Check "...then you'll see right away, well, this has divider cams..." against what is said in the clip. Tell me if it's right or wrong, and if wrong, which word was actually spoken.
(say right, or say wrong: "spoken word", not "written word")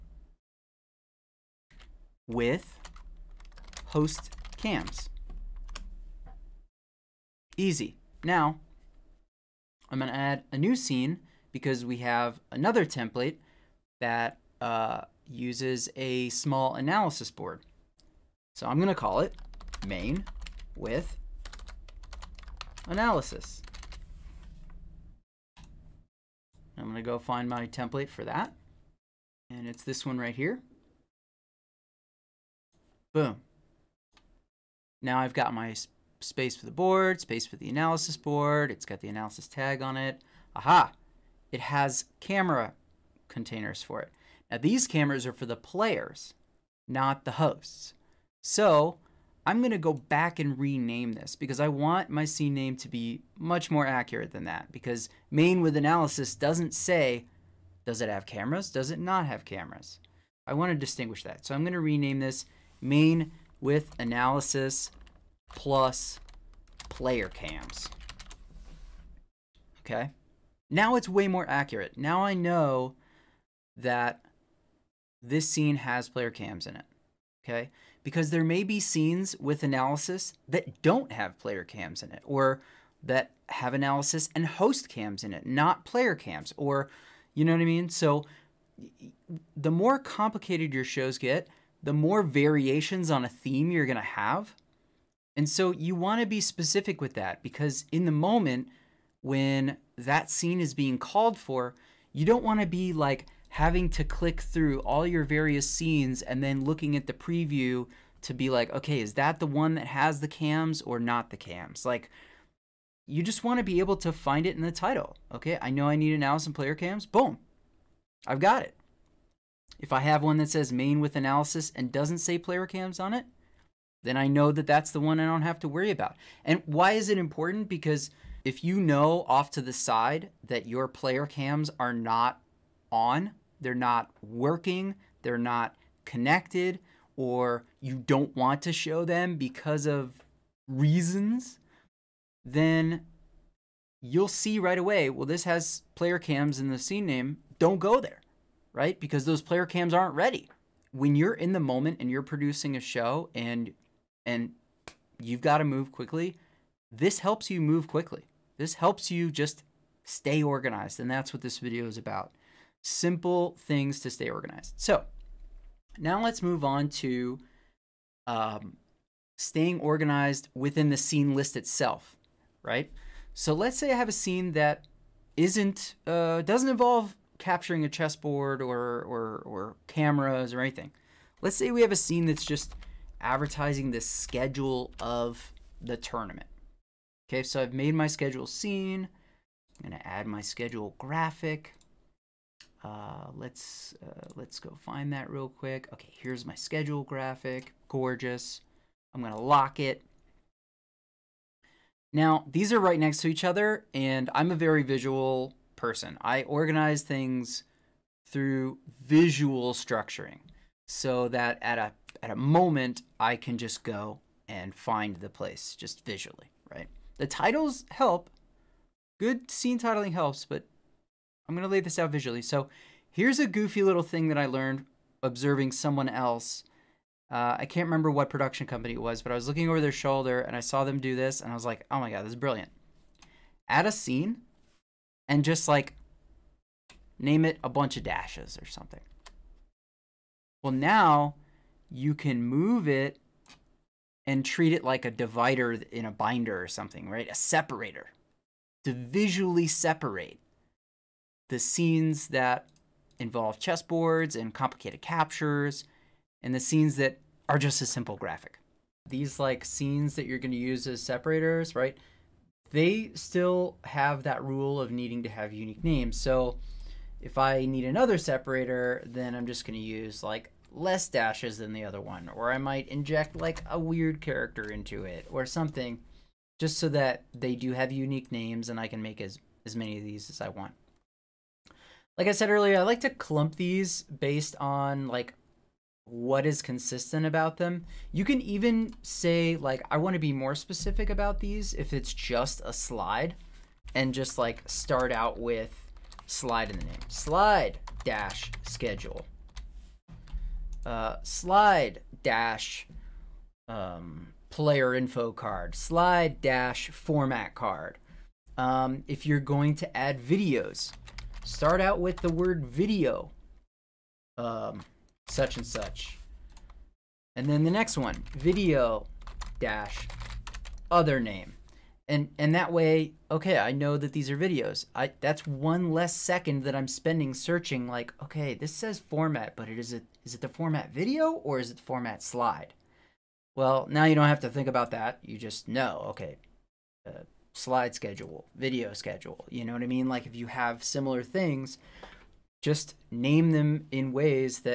wrong: "player", not "divider".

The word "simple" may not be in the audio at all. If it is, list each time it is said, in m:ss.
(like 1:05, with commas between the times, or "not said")
2:42, 4:17.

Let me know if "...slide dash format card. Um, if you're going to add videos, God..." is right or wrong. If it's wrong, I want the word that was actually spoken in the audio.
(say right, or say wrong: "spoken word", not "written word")
wrong: "Start", not "God".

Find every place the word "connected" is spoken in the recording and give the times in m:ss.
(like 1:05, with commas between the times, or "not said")
2:16.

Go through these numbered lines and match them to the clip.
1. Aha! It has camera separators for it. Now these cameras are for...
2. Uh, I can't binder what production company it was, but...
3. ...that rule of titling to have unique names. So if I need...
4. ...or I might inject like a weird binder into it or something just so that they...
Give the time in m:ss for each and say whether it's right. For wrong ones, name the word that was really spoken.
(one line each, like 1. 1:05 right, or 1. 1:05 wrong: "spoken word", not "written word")
1. 0:40 wrong: "containers", not "separators"
2. 3:47 wrong: "remember", not "binder"
3. 4:24 wrong: "needing", not "titling"
4. 4:32 wrong: "character", not "binder".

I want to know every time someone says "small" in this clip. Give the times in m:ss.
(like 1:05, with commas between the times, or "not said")
0:16.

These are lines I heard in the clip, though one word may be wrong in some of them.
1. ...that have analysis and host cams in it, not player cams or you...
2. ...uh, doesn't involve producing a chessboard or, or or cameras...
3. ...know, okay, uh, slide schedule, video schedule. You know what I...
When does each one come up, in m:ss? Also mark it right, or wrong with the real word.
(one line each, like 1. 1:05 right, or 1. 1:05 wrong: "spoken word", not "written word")
1. 1:23 right
2. 2:56 wrong: "capturing", not "producing"
3. 5:35 right.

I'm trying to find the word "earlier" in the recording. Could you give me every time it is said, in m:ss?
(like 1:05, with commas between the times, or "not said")
4:42.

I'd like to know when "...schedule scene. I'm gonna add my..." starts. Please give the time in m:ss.
3:08.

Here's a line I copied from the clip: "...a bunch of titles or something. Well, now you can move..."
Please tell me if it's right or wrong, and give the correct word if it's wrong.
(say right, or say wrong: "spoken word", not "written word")
wrong: "dashes", not "titles".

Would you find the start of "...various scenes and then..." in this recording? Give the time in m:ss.
1:45.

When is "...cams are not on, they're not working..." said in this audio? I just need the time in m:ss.
2:11.